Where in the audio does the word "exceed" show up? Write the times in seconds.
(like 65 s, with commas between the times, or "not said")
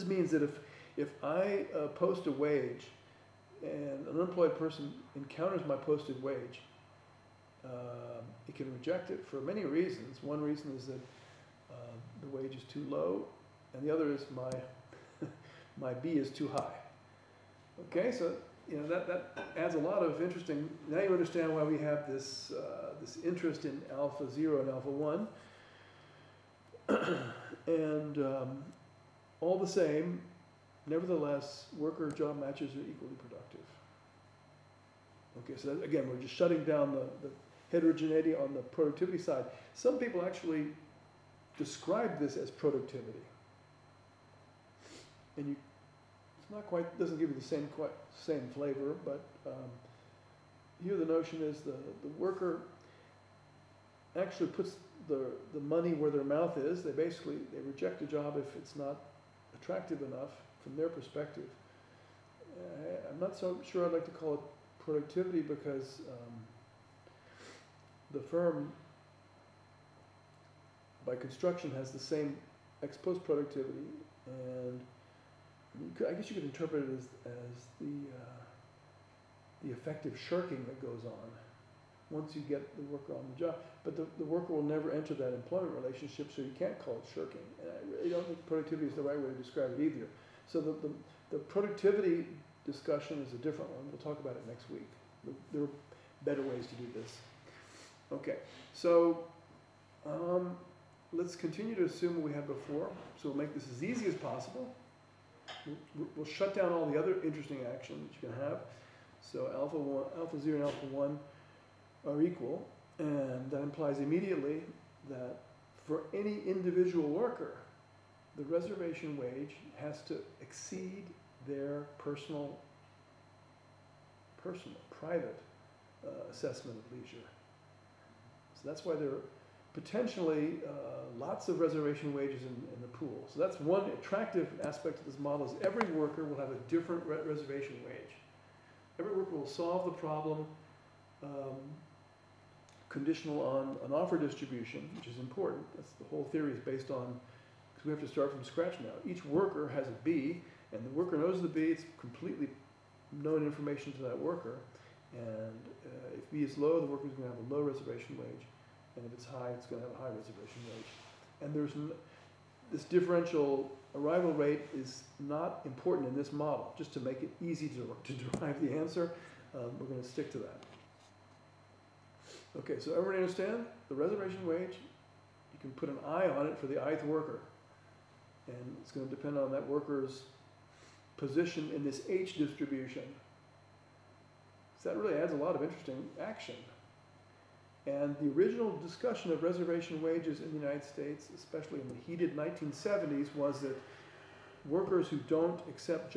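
120 s.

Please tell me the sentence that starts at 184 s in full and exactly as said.
So that really adds a lot of interesting action.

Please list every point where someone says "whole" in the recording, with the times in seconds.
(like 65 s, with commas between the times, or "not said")
146 s.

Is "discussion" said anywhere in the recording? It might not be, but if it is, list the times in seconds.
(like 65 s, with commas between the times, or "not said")
92 s, 188 s.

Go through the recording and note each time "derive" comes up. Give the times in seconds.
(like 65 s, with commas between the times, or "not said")
168 s.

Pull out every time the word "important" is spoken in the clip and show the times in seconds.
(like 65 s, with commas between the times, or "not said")
145 s, 165 s.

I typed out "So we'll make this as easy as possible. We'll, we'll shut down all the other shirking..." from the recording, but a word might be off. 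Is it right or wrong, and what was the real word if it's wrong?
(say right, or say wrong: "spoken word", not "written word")
wrong: "interesting", not "shirking".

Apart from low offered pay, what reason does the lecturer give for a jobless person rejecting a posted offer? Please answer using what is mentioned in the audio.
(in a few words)
B is too high.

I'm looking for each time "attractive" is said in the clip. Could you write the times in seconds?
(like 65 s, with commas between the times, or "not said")
59 s, 133 s.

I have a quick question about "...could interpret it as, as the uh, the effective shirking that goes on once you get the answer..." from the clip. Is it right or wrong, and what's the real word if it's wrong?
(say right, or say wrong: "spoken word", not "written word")
wrong: "worker", not "answer".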